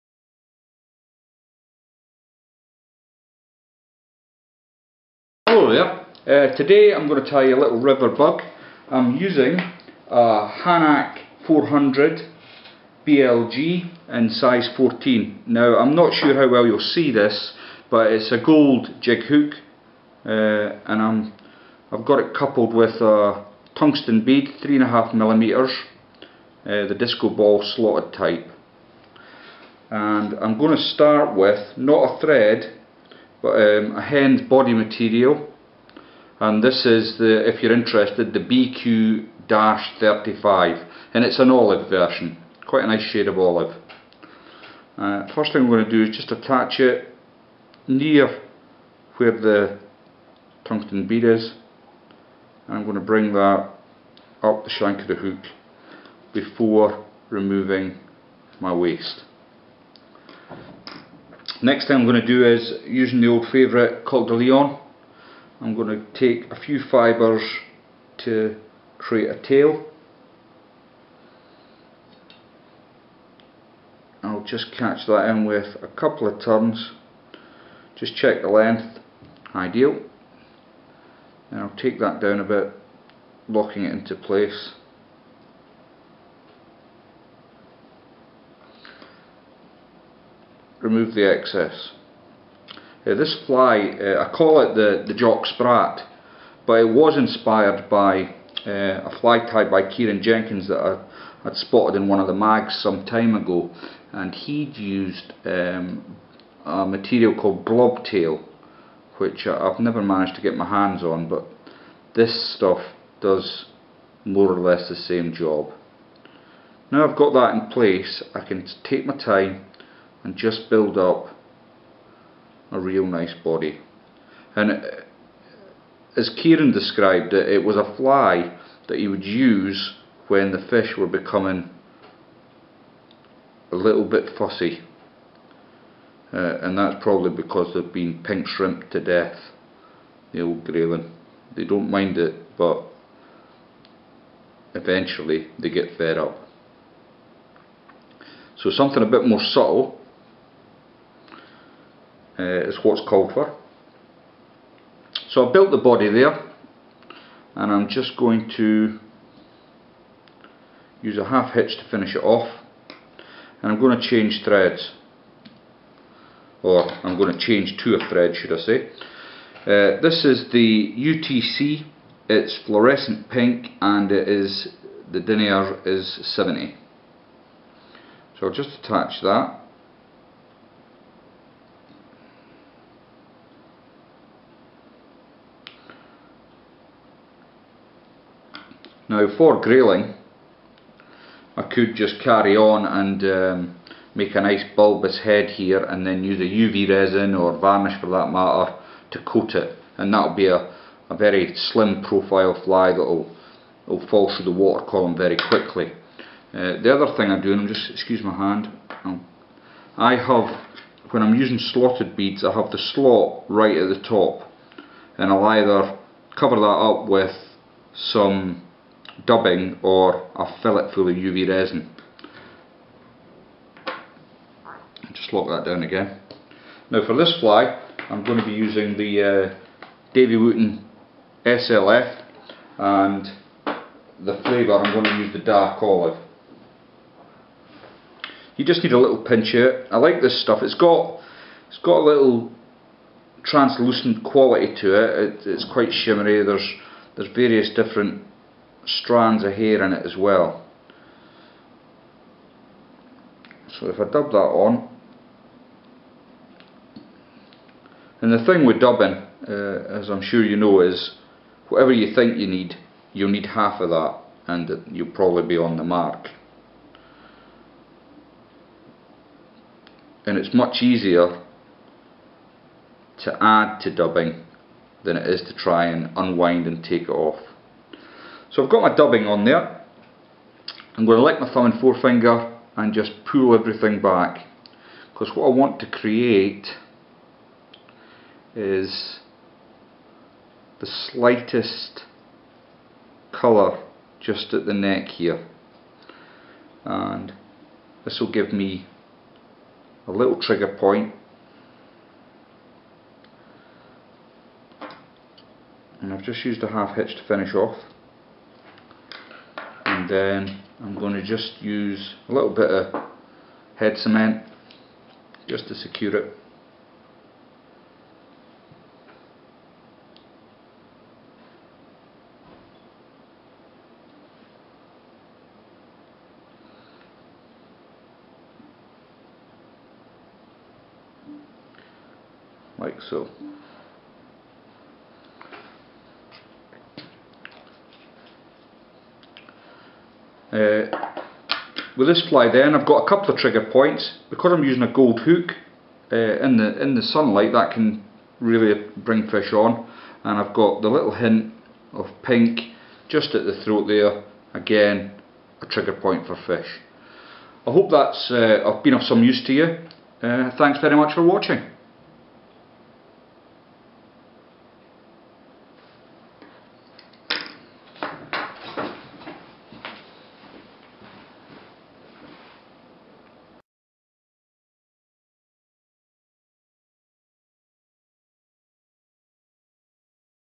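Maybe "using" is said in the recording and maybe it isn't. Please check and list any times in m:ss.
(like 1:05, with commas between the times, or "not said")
0:09, 1:02, 3:31, 3:48, 5:44.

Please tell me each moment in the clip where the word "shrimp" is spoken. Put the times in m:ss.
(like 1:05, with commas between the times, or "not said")
2:18.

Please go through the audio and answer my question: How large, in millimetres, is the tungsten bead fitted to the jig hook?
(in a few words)
3.5.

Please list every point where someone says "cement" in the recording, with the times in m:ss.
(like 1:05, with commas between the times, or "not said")
5:13.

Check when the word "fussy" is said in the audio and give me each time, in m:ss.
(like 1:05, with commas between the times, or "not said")
2:14.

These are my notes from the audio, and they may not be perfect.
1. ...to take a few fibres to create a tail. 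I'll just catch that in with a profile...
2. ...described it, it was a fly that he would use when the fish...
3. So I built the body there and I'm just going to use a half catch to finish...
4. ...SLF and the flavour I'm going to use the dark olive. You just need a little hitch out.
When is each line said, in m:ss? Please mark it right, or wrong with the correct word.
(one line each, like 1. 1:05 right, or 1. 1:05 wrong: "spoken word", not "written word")
1. 1:05 wrong: "couple", not "profile"
2. 2:06 right
3. 2:35 wrong: "hitch", not "catch"
4. 3:51 wrong: "pinch", not "hitch".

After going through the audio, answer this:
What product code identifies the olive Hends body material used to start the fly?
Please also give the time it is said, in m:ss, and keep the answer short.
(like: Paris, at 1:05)
BQ-35, at 0:38.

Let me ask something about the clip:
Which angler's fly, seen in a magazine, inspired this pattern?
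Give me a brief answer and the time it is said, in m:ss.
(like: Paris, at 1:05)
Kieran Jenkins, at 1:39.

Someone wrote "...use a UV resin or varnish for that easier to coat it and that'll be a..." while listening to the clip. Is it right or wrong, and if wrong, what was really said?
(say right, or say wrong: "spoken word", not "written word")
wrong: "matter", not "easier".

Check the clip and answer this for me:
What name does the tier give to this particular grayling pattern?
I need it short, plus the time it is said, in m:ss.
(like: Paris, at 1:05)
Jock Sprat, at 1:35.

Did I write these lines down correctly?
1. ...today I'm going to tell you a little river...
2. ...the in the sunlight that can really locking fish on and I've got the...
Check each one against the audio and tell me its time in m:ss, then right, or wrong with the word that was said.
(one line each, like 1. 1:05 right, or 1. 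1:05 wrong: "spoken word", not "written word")
1. 0:06 right
2. 5:46 wrong: "bring", not "locking".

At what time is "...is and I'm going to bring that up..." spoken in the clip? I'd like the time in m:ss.
0:51.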